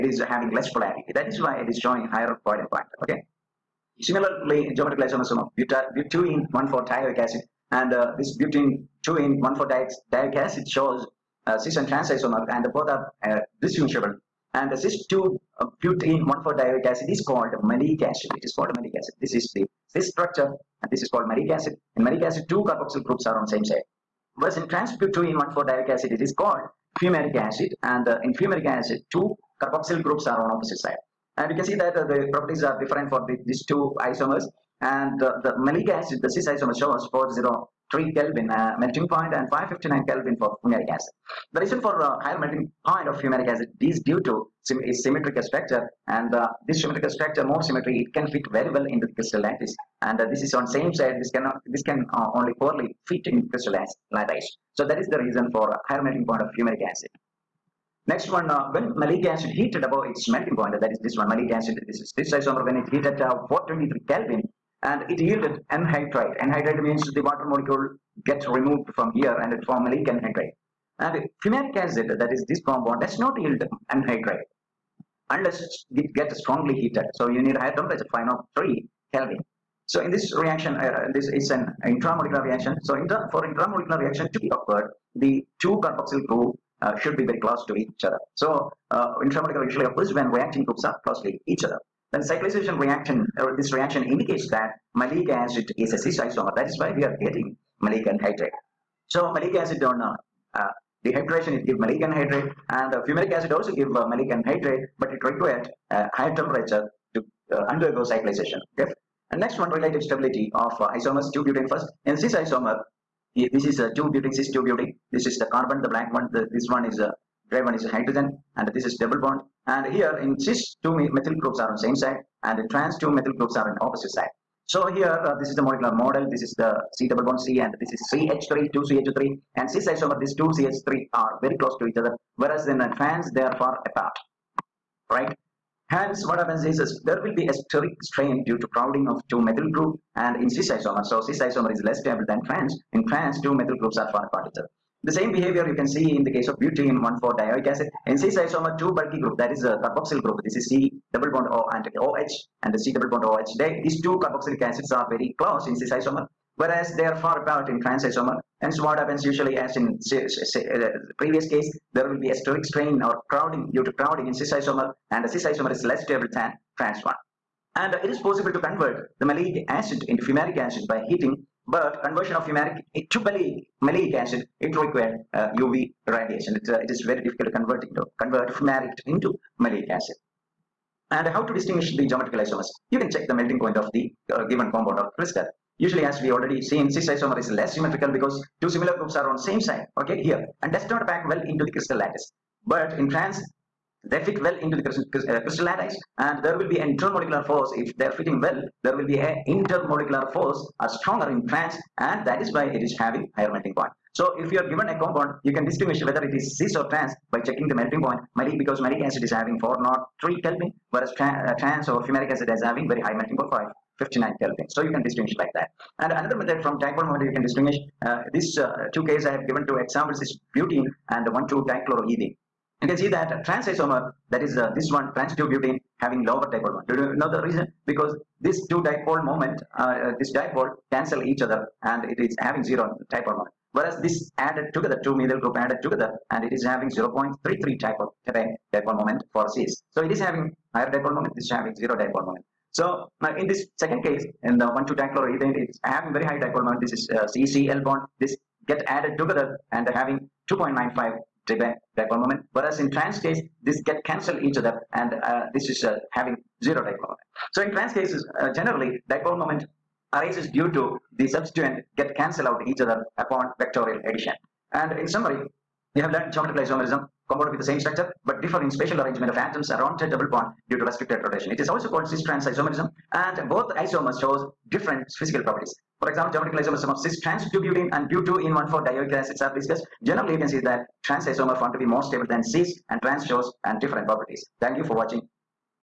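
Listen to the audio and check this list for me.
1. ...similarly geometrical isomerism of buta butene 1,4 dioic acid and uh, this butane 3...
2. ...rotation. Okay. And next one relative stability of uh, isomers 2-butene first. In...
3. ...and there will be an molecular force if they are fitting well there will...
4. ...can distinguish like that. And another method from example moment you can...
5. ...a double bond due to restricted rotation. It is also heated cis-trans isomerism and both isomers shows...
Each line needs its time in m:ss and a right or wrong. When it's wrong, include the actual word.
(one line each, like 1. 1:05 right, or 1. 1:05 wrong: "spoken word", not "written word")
1. 0:04 wrong: "2", not "3"
2. 1:48 wrong: "cyclization", not "rotation"
3. 3:16 wrong: "intermolecular", not "molecular"
4. 3:34 wrong: "dipole", not "example"
5. 4:30 wrong: "called", not "heated".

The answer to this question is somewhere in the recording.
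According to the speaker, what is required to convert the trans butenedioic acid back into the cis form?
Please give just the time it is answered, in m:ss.
2:55.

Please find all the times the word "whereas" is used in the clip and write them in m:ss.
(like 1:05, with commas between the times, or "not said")
0:24, 2:12, 2:36, 3:30, 3:53, 4:12.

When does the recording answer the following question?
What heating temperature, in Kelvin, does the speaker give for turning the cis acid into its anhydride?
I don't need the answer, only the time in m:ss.
1:03.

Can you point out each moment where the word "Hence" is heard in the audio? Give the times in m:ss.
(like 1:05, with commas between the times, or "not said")
2:15, 2:38.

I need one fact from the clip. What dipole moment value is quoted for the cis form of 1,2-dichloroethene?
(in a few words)
2.95.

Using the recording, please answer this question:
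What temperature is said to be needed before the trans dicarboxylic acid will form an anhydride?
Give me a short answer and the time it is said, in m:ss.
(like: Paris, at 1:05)
503 Kelvin, at 1:18.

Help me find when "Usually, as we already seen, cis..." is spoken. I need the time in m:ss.
3:05.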